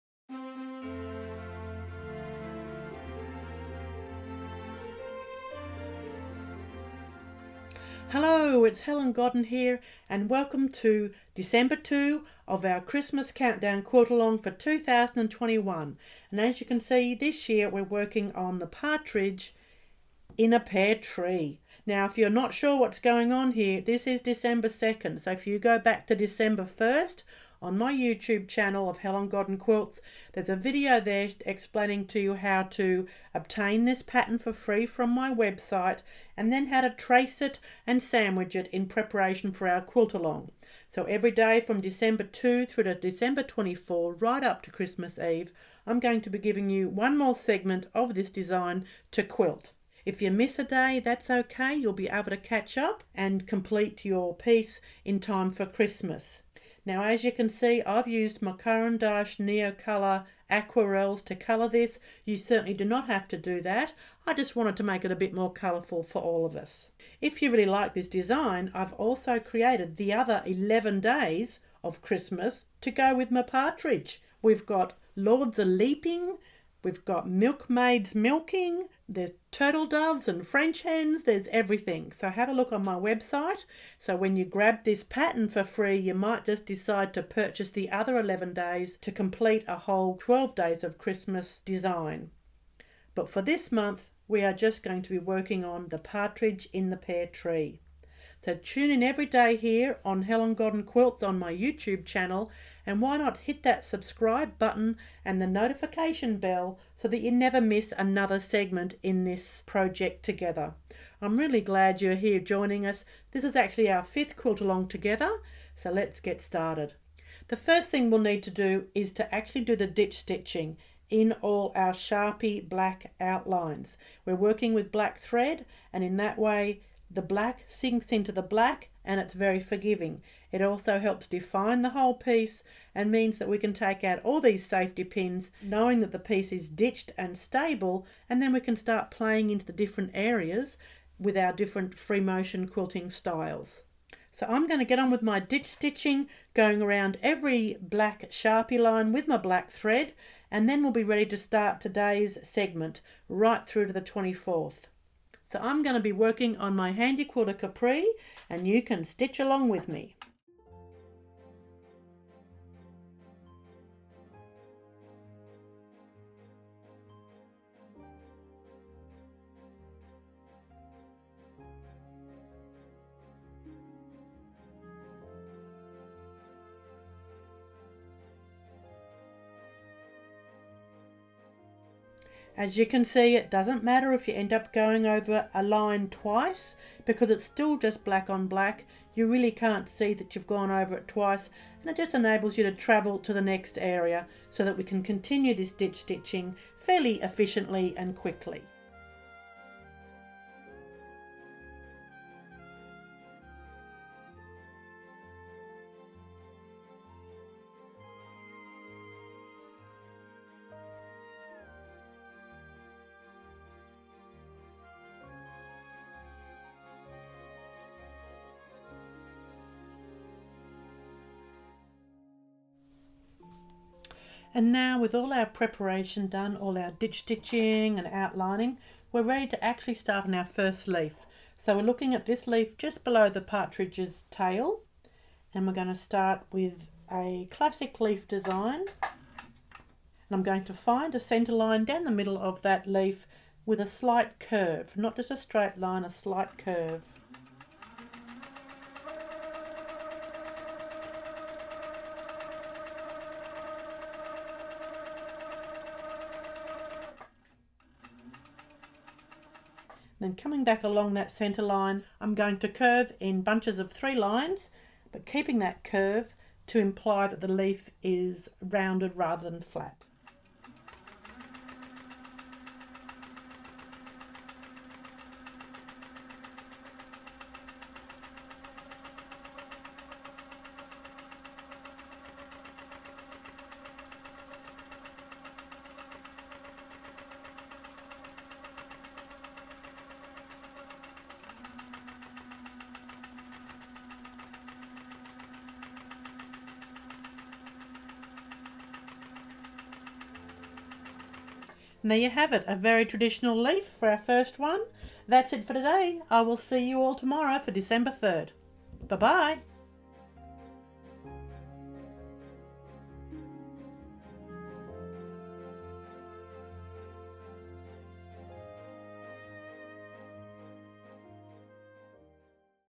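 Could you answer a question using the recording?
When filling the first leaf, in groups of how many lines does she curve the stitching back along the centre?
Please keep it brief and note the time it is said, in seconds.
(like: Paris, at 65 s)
3, at 263 s.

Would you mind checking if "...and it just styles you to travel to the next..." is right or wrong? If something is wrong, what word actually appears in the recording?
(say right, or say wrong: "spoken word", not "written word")
wrong: "enables", not "styles".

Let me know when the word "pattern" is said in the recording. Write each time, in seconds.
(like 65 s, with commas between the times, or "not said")
34 s, 85 s.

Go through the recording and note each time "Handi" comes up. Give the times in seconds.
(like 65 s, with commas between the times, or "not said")
156 s.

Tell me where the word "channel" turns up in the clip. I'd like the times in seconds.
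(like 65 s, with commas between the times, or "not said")
28 s, 102 s.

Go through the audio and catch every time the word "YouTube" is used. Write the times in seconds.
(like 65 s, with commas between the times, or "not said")
27 s, 101 s.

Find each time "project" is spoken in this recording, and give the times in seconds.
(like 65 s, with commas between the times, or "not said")
109 s.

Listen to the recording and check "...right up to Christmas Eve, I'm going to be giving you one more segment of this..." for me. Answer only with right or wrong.
right.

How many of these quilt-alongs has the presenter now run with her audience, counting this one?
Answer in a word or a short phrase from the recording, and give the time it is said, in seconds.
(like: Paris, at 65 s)
5, at 114 s.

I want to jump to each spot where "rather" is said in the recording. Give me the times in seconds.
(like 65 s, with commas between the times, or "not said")
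269 s.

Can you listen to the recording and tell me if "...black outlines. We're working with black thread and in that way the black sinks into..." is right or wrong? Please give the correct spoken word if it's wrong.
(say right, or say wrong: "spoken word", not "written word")
right.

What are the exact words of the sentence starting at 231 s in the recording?
So we're looking at this leaf just below the partridge's tail and we're going to start with a classic leaf design.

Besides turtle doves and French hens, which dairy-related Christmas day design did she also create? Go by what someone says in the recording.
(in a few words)
Milkmaids Milking.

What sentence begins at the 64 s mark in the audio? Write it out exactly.
I just wanted to make it a bit more colourful for all of us.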